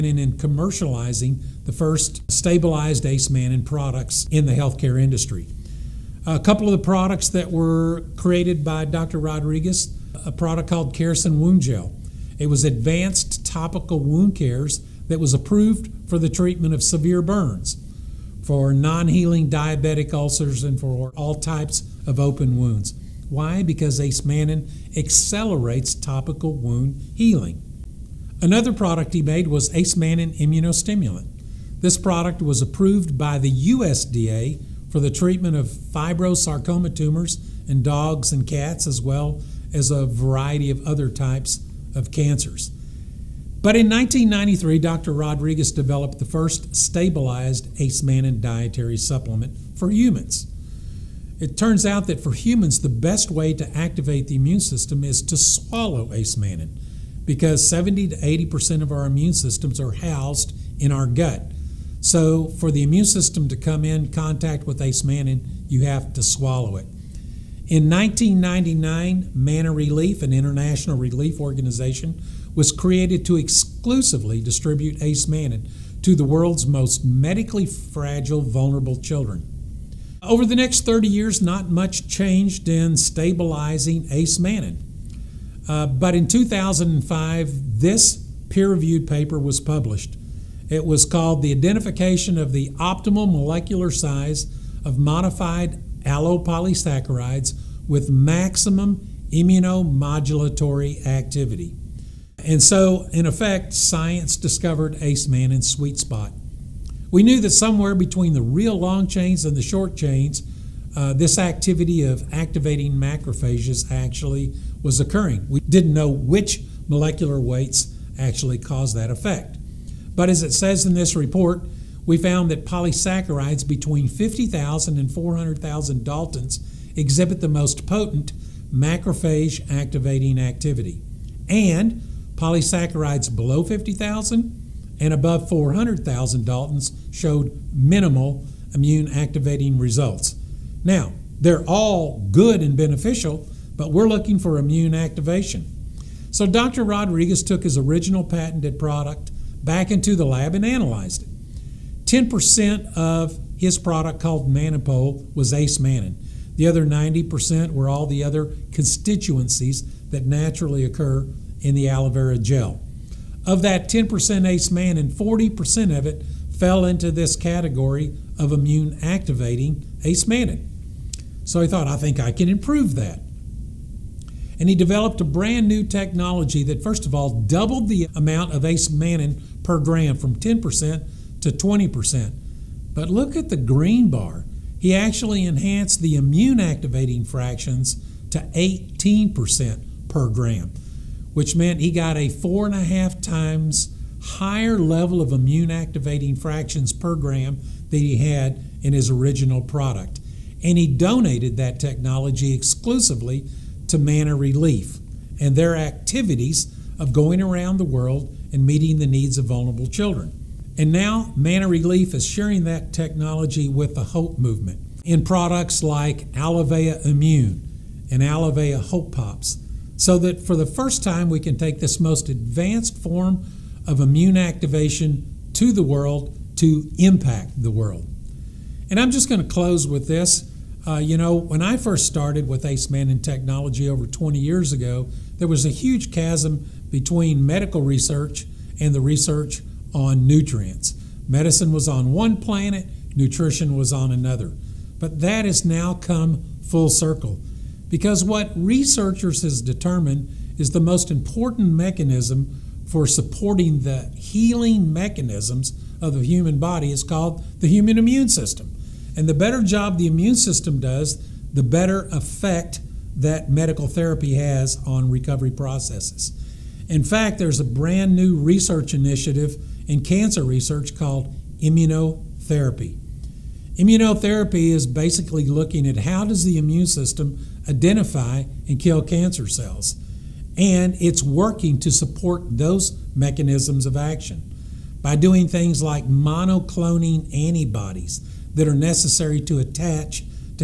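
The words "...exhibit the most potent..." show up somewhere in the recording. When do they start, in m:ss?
2:06.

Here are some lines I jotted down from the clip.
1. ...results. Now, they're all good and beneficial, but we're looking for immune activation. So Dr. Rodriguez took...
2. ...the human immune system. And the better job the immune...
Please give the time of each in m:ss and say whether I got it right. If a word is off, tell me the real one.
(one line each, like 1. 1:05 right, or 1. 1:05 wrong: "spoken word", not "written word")
1. 2:19 right
2. 4:17 right.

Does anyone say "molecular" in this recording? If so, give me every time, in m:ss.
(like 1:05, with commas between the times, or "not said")
1:33, 1:56.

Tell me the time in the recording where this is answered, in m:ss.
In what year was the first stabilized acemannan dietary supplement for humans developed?
0:43.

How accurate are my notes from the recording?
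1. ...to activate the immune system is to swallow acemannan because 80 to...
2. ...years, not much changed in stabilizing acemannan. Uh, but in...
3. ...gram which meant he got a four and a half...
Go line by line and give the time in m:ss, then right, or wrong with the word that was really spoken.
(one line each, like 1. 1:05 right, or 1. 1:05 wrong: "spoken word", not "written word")
1. 0:53 wrong: "70", not "80"
2. 1:21 right
3. 3:10 right.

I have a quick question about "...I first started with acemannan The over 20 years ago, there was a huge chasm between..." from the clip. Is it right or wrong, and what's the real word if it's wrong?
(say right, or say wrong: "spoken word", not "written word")
wrong: "Technology", not "The".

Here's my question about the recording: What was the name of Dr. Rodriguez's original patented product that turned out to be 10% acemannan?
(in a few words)
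Manapol.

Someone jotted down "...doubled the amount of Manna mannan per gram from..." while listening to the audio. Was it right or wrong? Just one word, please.
wrong.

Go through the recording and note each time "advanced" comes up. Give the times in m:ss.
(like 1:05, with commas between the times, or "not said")
0:12, 3:42.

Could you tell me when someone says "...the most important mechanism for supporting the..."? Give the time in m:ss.
4:10.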